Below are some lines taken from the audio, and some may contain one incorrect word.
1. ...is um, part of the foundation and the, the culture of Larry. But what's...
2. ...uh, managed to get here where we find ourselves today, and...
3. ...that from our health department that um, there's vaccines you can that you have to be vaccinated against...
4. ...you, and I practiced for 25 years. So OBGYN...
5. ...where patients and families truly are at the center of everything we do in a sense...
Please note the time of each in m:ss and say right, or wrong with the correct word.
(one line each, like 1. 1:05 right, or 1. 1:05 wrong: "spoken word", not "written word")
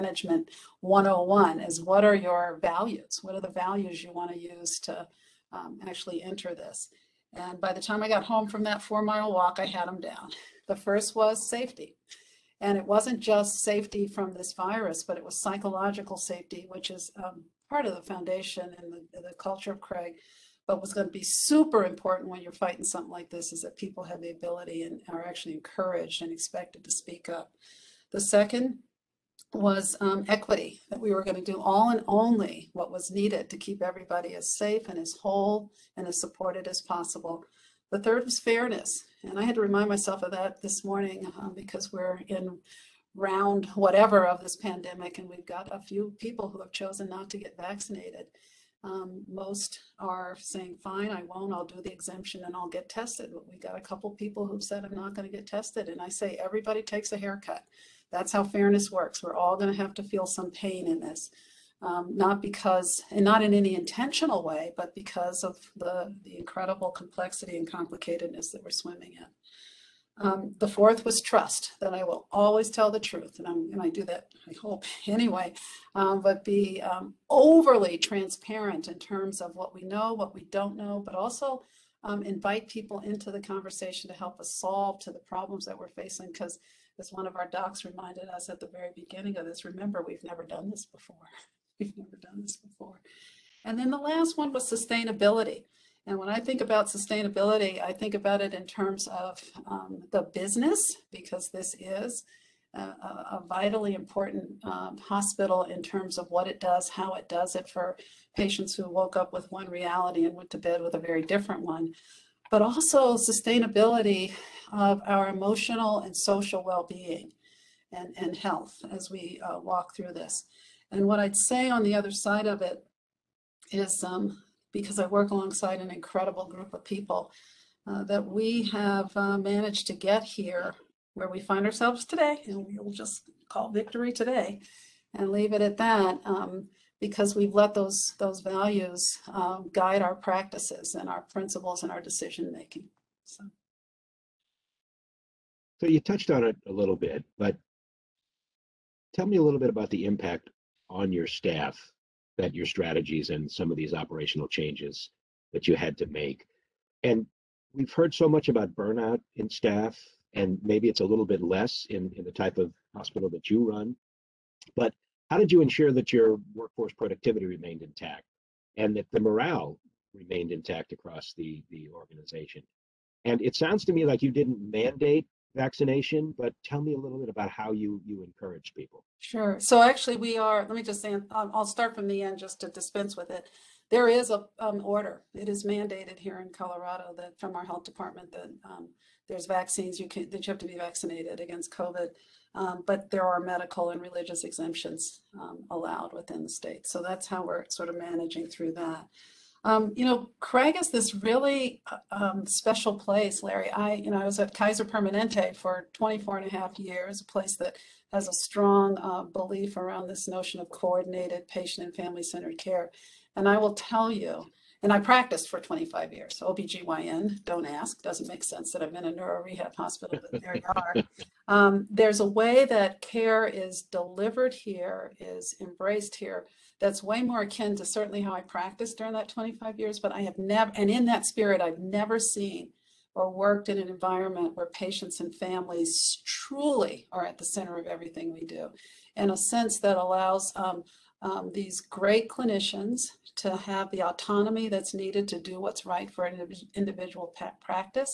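1. 0:16 wrong: "Craig", not "Larry"
2. 2:09 right
3. 3:07 right
4. 3:34 right
5. 3:54 right.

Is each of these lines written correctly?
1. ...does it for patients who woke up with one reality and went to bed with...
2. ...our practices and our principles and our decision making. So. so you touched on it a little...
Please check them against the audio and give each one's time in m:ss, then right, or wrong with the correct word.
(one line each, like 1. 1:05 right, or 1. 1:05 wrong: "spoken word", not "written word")
1. 1:47 right
2. 2:20 right.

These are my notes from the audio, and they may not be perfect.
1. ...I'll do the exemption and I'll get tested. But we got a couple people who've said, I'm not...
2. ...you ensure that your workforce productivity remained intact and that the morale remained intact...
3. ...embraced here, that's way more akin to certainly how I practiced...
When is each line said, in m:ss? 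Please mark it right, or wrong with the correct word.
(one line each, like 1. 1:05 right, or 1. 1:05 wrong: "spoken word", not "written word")
1. 0:51 right
2. 2:45 right
3. 3:45 right.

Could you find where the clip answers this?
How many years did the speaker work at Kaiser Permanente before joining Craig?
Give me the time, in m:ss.
3:25.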